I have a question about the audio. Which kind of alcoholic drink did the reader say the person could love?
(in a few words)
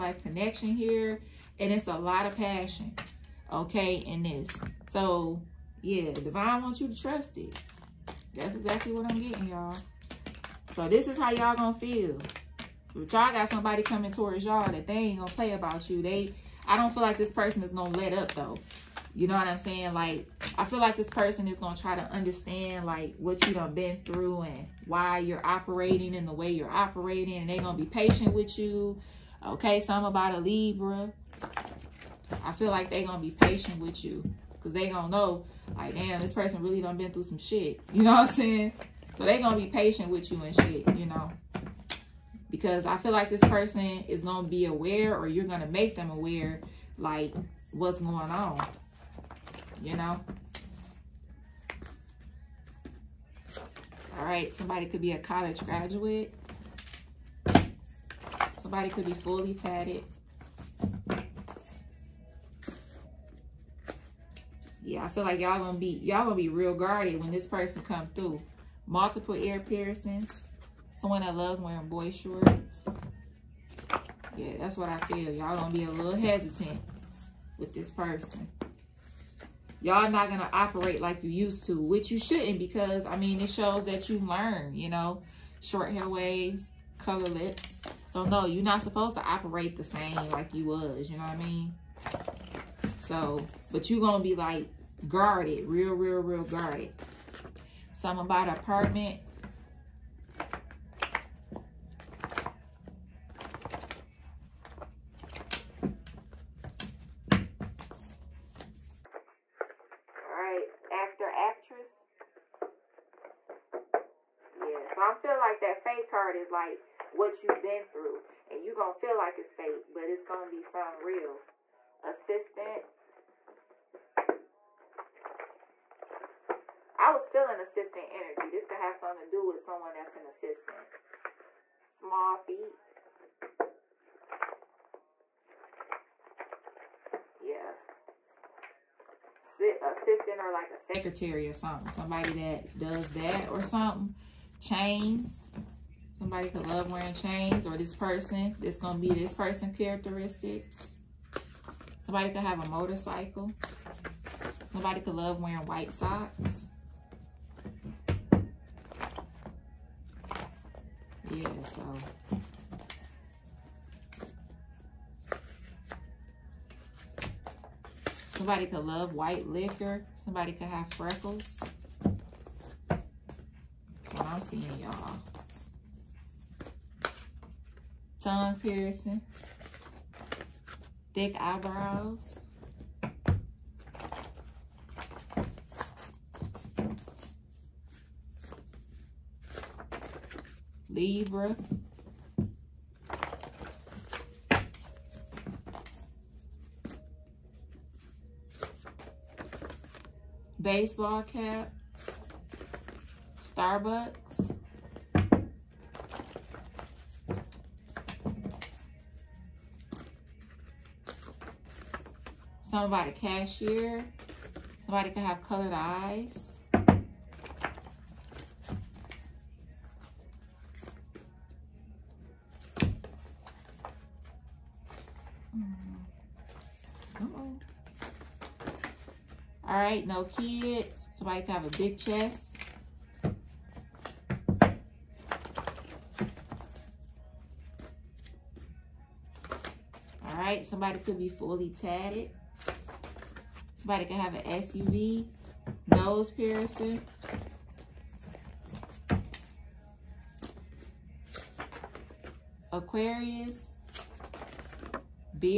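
White liquor.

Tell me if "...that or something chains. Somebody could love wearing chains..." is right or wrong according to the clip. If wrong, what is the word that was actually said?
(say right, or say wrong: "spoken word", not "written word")
right.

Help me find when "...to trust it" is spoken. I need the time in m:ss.
0:06.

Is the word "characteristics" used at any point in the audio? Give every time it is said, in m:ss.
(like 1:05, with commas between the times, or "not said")
2:29.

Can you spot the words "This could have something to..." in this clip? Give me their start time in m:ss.
2:08.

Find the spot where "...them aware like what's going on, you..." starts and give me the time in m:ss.
0:45.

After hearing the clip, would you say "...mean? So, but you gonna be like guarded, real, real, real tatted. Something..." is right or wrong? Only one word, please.
wrong.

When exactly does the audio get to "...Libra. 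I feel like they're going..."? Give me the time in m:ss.
0:30.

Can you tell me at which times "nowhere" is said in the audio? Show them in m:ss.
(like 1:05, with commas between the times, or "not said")
not said.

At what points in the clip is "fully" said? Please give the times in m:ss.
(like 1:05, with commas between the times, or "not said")
0:59, 4:01.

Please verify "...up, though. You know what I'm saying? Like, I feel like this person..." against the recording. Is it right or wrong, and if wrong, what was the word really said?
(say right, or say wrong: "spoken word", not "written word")
right.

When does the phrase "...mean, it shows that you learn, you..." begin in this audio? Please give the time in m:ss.
1:23.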